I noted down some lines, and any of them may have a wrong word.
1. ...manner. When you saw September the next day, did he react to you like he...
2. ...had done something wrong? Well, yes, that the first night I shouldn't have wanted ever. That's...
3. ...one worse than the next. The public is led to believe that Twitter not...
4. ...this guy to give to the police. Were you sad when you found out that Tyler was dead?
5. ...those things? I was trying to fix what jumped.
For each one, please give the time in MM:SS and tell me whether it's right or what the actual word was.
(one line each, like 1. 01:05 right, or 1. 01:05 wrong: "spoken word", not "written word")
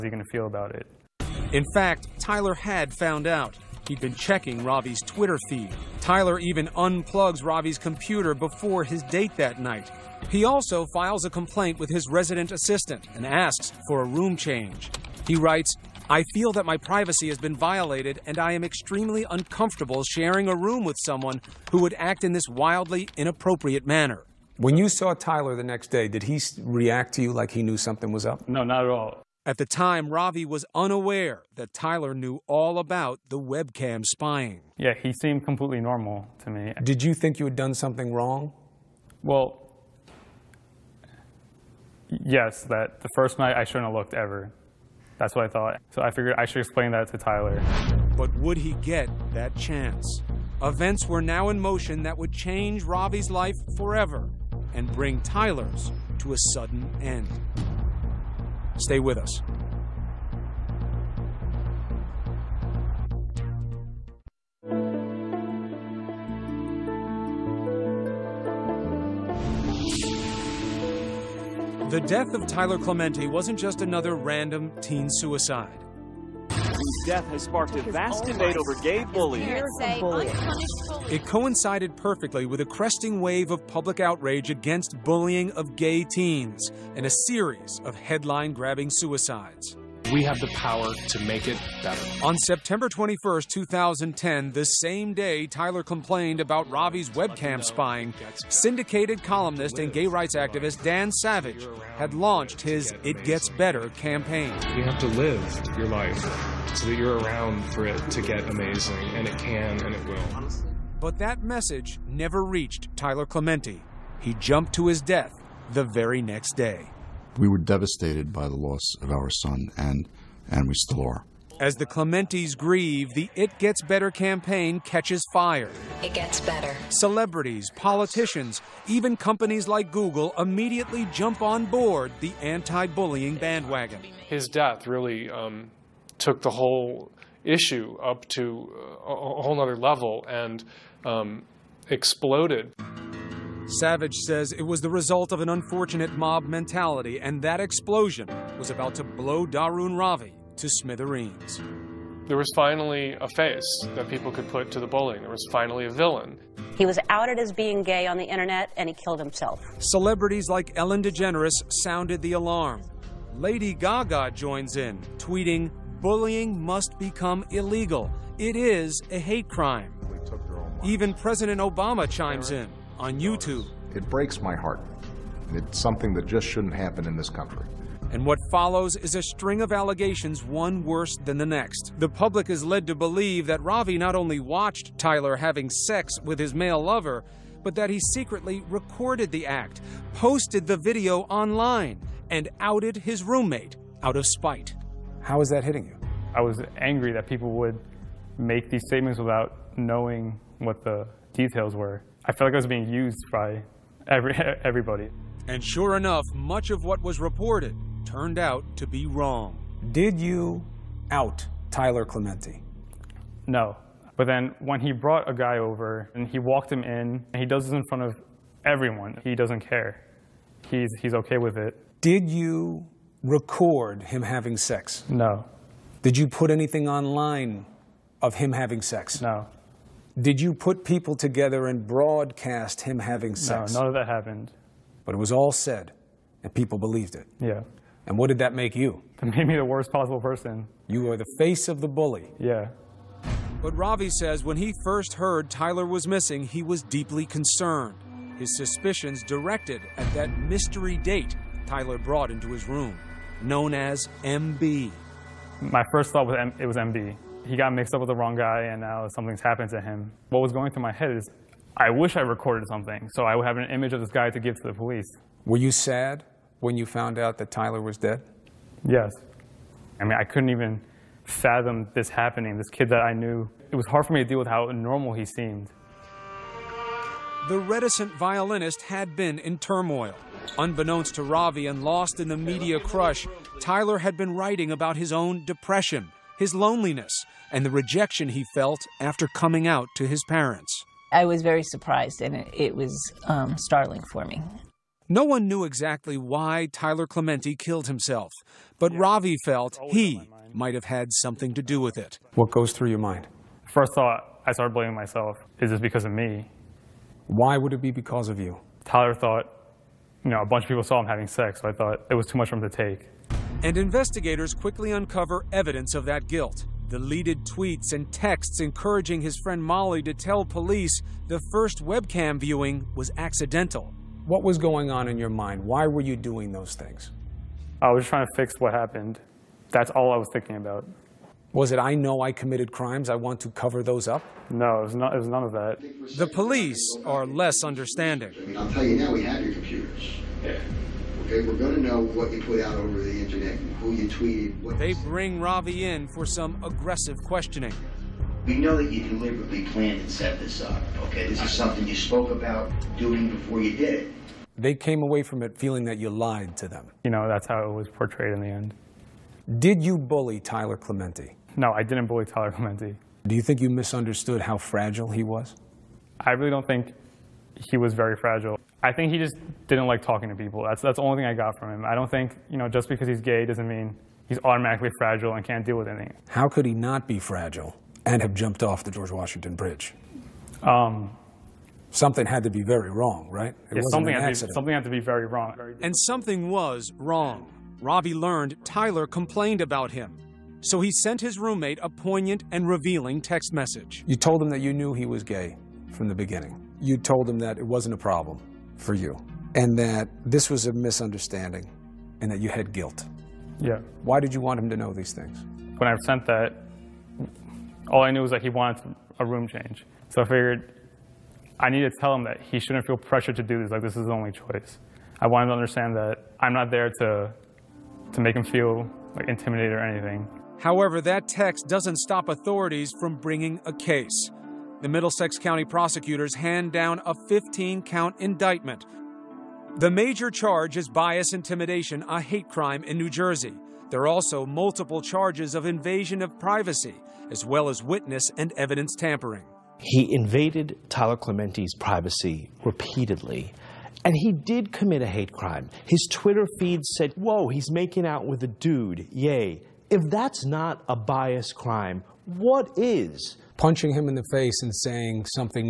1. 00:23 wrong: "Tyler", not "September"
2. 00:37 wrong: "looked", not "wanted"
3. 03:00 wrong: "Ravi", not "Twitter"
4. 04:24 right
5. 05:26 wrong: "happened", not "jumped".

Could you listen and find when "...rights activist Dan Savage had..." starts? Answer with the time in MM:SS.
01:40.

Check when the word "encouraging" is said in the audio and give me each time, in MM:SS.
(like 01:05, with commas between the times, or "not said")
05:18.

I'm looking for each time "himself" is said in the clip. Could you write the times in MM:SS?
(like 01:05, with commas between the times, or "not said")
02:39, 04:57.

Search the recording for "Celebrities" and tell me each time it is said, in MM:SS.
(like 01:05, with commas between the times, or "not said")
02:06, 02:39.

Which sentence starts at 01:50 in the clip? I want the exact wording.
But that message never reached Tyler Clementi.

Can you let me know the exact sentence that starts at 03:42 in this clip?
Did you record him having sex?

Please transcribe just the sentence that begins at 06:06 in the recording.
I really don't think he was very fragile.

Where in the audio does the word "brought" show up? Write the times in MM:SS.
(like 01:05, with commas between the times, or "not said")
03:34, 04:11.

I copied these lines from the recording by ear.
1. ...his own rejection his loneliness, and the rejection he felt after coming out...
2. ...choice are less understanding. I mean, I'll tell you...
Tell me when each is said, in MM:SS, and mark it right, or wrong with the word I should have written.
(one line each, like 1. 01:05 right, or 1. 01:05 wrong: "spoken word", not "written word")
1. 04:44 wrong: "depression", not "rejection"
2. 05:36 wrong: "police", not "choice".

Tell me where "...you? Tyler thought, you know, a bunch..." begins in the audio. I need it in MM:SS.
05:08.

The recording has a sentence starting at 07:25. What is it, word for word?
His Twitter feed said, Whoa, he's making out with a dude, yay.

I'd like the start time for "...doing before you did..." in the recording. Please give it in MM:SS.
05:52.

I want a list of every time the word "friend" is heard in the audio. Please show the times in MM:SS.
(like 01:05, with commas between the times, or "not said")
05:19.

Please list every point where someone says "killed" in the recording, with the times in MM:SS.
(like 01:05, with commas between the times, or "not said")
02:38, 04:57.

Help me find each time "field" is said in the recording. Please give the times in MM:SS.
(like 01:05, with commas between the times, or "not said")
not said.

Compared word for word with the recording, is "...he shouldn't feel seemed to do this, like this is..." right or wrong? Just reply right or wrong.
wrong.